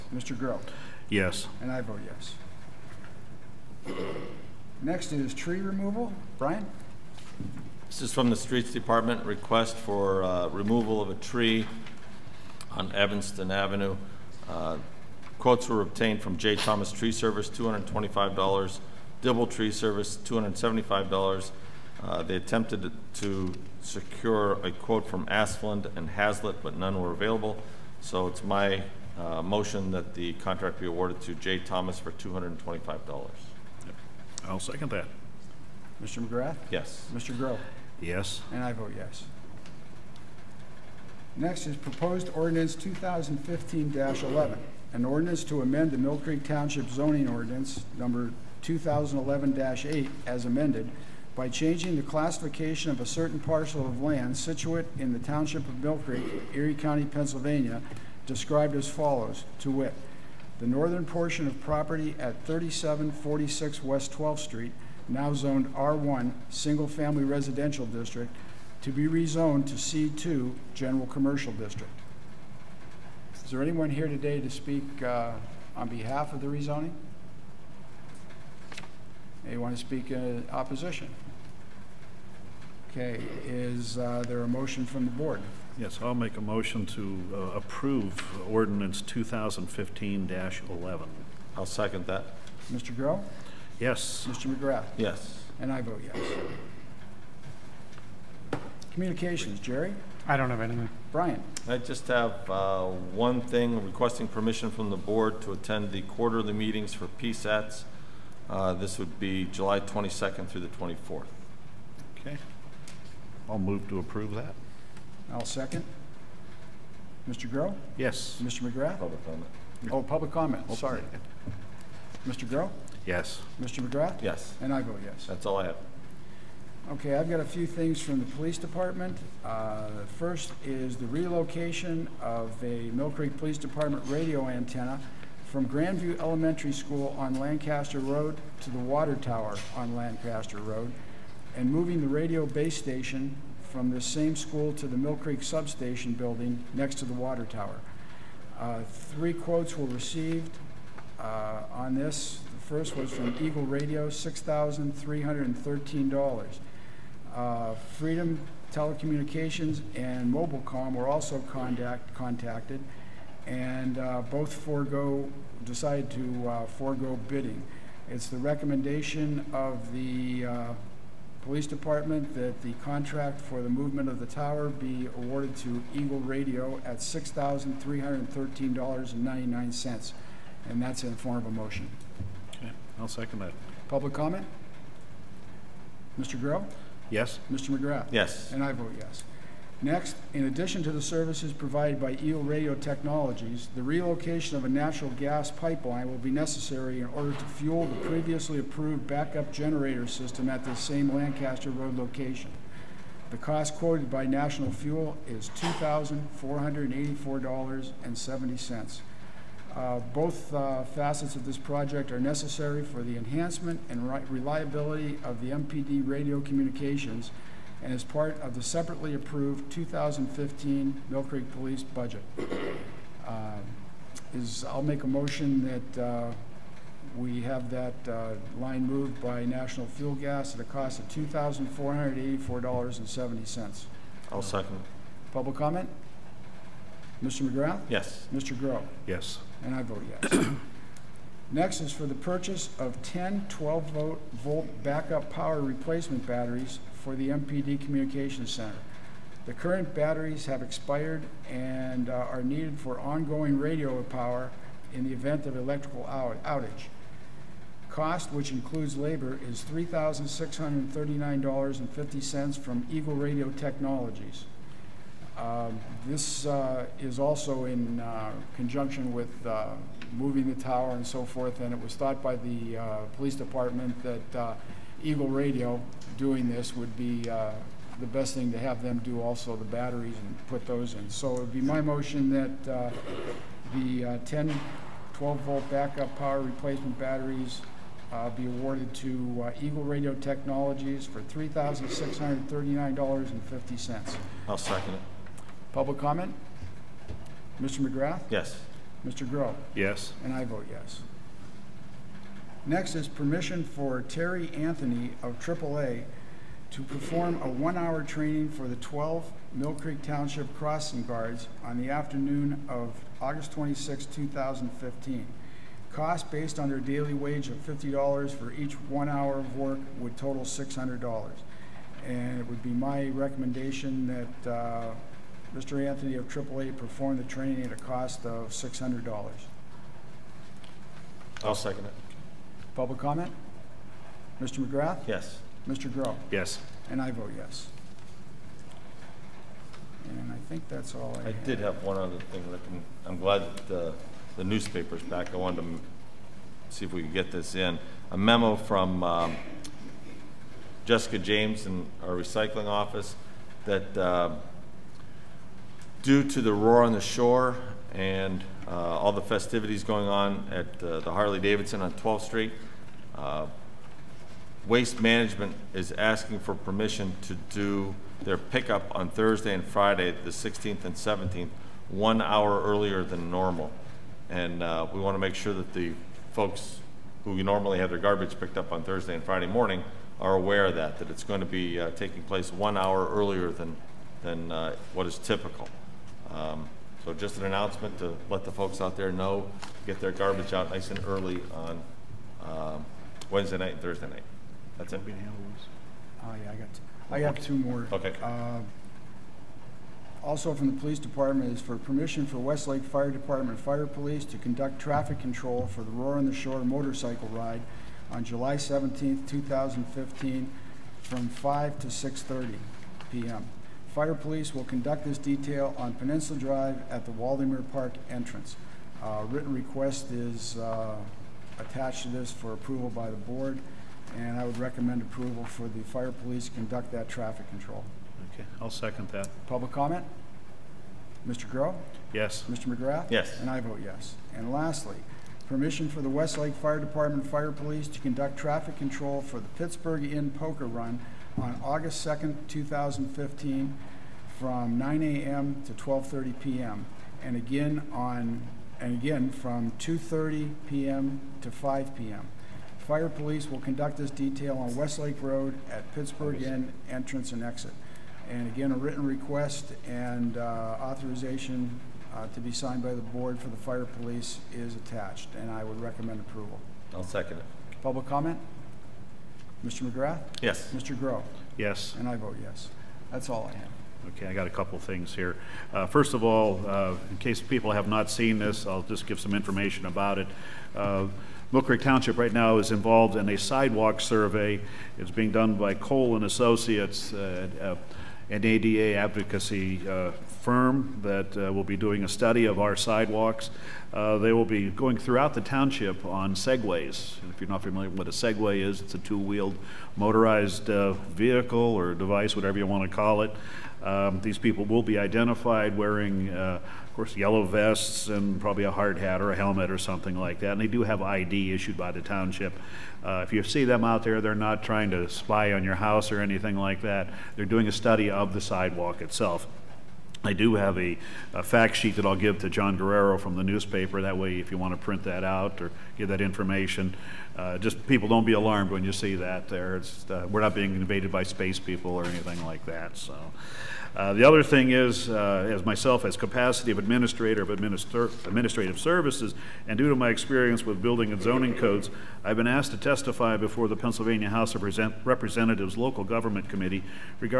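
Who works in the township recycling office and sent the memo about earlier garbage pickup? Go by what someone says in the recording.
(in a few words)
Jessica James.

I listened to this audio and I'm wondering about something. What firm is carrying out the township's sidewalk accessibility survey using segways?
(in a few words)
Cole and Associates.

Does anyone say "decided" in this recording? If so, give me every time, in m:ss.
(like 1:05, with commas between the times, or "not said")
2:45.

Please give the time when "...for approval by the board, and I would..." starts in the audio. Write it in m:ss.
7:02.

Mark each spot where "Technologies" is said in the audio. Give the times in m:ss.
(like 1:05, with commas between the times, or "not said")
3:12, 4:23, 4:50.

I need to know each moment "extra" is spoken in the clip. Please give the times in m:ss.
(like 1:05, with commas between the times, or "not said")
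not said.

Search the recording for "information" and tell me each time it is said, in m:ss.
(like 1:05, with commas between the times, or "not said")
7:59, 8:46.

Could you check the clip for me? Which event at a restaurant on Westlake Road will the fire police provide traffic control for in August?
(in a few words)
Pittsburgh Inn Poker Run.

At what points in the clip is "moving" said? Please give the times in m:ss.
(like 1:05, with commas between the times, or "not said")
2:21, 4:30.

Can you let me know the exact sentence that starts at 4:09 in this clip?
The current batteries have expired and uh, are needed for ongoing radio power in the event of electrical out outage.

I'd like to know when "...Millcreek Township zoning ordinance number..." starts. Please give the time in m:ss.
0:45.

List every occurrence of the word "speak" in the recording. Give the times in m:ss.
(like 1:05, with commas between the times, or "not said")
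1:14, 1:19.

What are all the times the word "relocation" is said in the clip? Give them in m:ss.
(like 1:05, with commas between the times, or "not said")
2:11, 3:13.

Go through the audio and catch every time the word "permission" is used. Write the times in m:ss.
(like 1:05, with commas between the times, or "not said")
1:44, 5:03, 6:06, 6:41, 7:15.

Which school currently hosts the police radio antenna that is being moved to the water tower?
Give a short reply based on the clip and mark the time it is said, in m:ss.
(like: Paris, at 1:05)
Grandview Elementary School, at 2:15.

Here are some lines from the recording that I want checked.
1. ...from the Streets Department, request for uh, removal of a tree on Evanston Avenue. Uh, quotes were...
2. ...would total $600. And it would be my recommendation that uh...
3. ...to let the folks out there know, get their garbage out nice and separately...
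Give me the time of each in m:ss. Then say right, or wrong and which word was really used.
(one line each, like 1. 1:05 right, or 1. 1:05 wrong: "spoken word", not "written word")
1. 0:08 right
2. 5:19 right
3. 6:27 wrong: "early", not "separately".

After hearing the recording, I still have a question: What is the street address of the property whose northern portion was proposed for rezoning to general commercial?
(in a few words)
3746 West 12th Street.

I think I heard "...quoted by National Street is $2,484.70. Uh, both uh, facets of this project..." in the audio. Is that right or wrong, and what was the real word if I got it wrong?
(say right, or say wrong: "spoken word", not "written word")
wrong: "Fuel", not "Street".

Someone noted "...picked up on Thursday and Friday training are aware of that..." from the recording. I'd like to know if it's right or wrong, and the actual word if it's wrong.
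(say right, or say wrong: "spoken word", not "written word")
wrong: "morning", not "training".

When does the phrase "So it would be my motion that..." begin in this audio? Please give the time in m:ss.
4:41.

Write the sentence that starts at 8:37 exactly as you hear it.
They're doing a study of the sidewalk itself.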